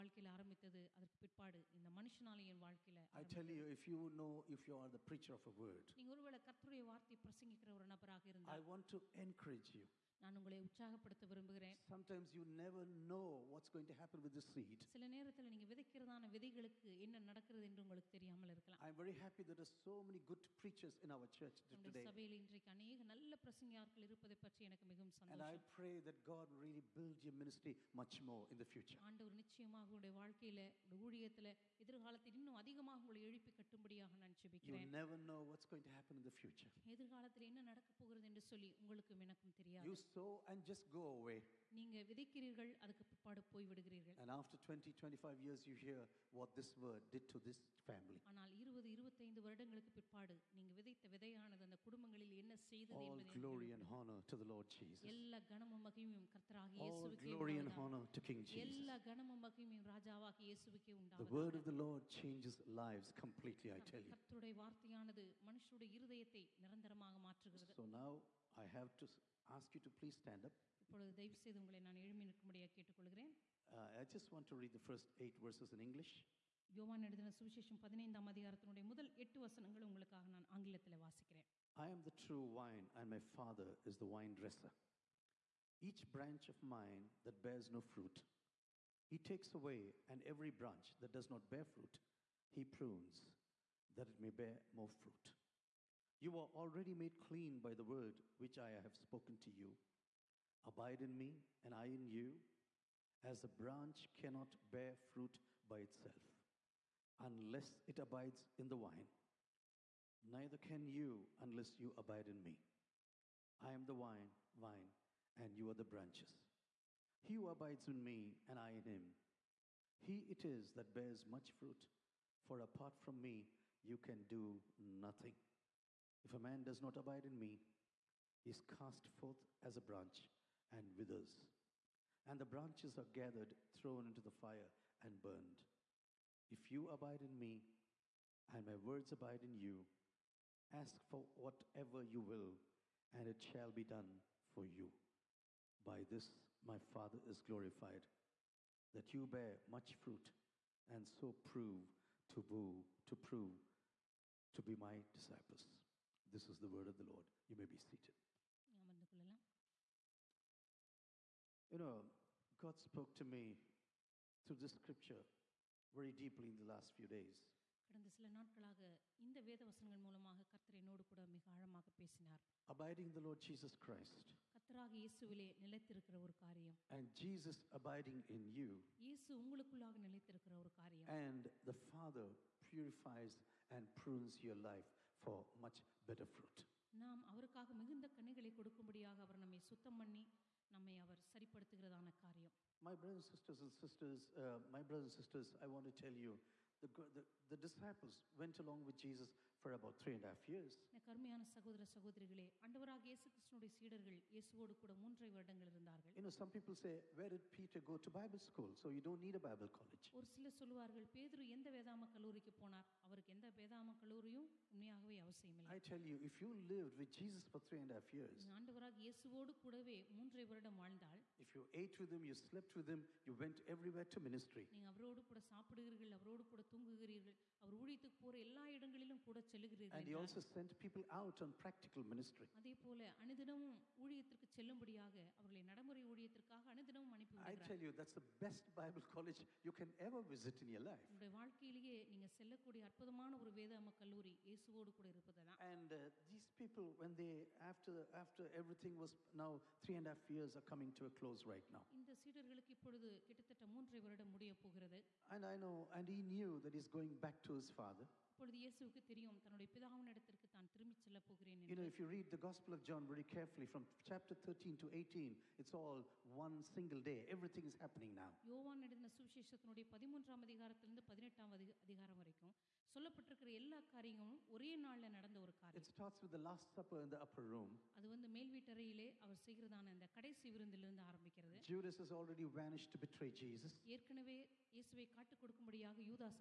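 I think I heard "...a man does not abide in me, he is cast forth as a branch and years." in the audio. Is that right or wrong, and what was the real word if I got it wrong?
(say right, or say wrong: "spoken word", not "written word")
wrong: "withers", not "years".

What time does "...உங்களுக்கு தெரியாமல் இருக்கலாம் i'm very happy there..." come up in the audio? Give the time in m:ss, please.
0:17.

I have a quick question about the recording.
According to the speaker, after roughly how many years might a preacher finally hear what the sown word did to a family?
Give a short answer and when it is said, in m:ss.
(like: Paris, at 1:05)
20 25 years, at 0:44.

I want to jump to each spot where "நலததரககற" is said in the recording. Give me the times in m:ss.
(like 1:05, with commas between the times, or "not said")
2:55, 3:00.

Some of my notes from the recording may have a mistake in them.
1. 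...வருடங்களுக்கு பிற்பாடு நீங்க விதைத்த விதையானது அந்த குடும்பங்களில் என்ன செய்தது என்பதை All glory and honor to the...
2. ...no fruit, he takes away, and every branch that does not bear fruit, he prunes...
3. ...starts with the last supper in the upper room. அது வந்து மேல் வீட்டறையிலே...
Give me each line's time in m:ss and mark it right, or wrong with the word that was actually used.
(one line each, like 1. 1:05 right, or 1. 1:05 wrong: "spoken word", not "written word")
1. 0:49 right
2. 1:27 right
3. 4:35 right.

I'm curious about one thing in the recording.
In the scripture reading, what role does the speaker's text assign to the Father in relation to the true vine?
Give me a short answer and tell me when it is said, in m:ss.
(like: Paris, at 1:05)
wine dresser, at 1:24.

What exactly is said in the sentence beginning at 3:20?
You know some people say where did Peter go to Bible school so you don't need a Bible college.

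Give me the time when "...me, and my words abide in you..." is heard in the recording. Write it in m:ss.
2:17.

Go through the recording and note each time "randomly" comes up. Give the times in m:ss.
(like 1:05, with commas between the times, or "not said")
not said.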